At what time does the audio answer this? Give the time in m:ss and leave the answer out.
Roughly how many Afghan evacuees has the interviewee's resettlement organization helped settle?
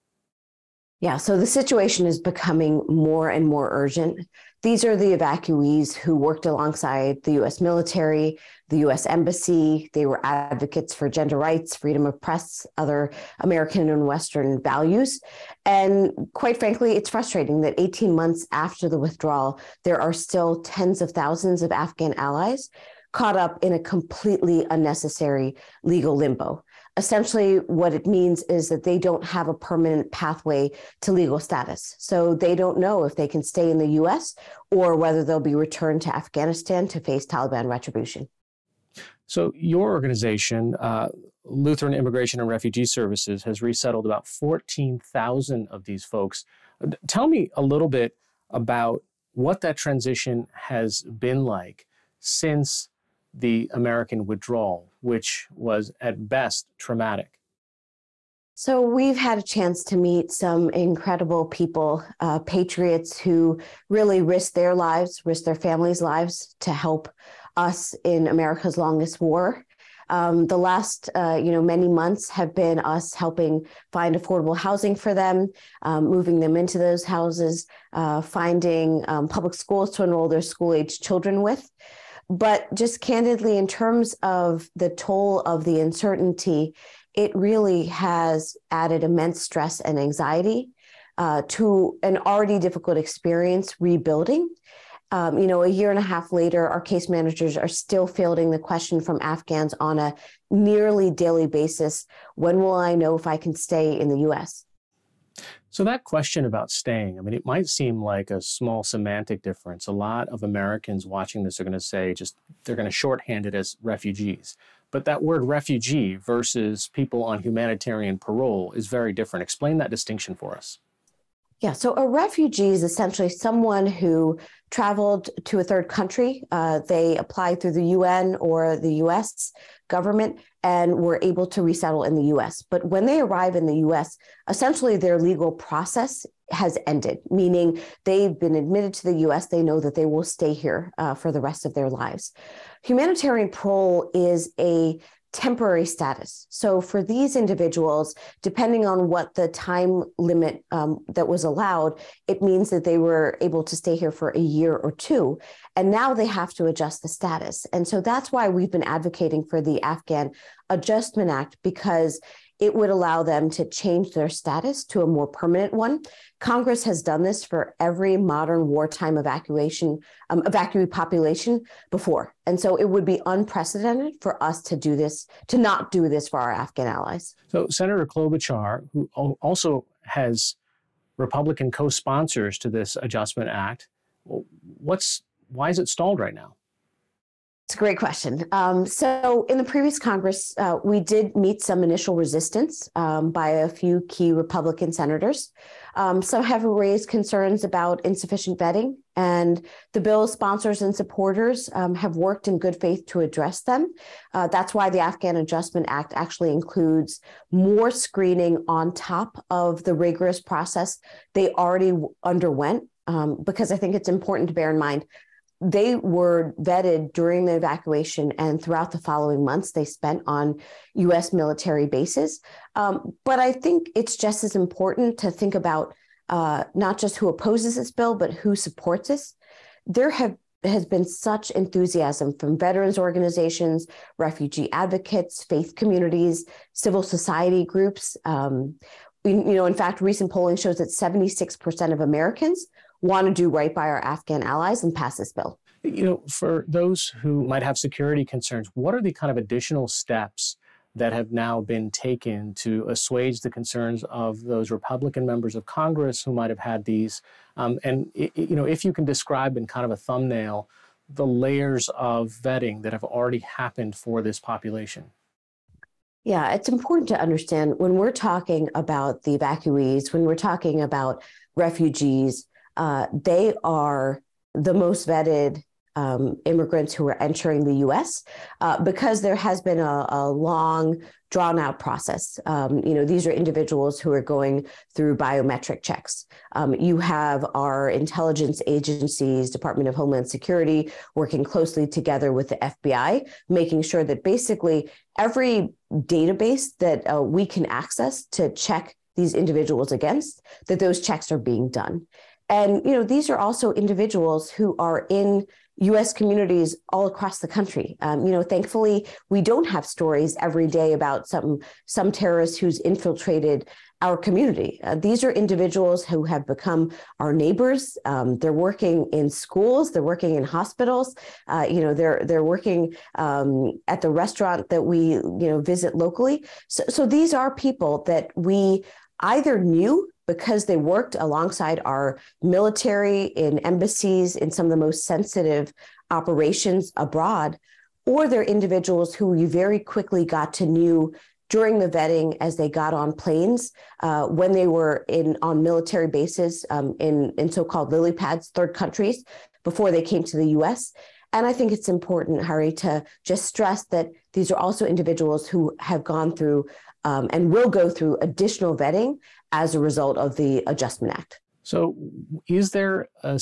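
0:44.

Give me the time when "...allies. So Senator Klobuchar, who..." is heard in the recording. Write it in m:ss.
2:56.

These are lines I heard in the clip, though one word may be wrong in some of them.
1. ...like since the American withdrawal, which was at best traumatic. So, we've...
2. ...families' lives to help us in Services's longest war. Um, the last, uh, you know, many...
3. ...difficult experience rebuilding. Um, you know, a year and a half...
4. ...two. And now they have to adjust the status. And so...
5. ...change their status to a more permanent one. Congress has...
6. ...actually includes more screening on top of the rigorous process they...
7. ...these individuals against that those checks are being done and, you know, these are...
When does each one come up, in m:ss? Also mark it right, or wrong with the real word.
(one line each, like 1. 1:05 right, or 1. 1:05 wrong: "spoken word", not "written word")
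1. 0:51 right
2. 1:05 wrong: "America", not "Services"
3. 1:32 right
4. 2:34 right
5. 2:43 right
6. 3:26 right
7. 4:59 right.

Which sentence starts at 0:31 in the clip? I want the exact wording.
So they don't know if they can stay in the US or whether they'll be returned to Afghanistan to face Taliban retribution.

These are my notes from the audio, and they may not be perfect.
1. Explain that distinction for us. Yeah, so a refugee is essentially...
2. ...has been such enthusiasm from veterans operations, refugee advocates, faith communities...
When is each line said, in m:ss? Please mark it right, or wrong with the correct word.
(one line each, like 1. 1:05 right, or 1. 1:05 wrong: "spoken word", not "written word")
1. 1:59 right
2. 3:50 wrong: "organizations", not "operations".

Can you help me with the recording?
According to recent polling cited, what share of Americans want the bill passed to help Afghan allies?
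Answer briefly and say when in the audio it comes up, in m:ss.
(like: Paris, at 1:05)
76%, at 4:00.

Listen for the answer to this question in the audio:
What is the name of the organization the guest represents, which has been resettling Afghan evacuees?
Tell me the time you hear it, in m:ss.
0:41.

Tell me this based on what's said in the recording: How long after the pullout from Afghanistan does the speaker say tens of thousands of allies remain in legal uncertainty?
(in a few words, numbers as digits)
18 months.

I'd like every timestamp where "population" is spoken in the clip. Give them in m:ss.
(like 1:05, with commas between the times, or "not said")
2:50, 4:24.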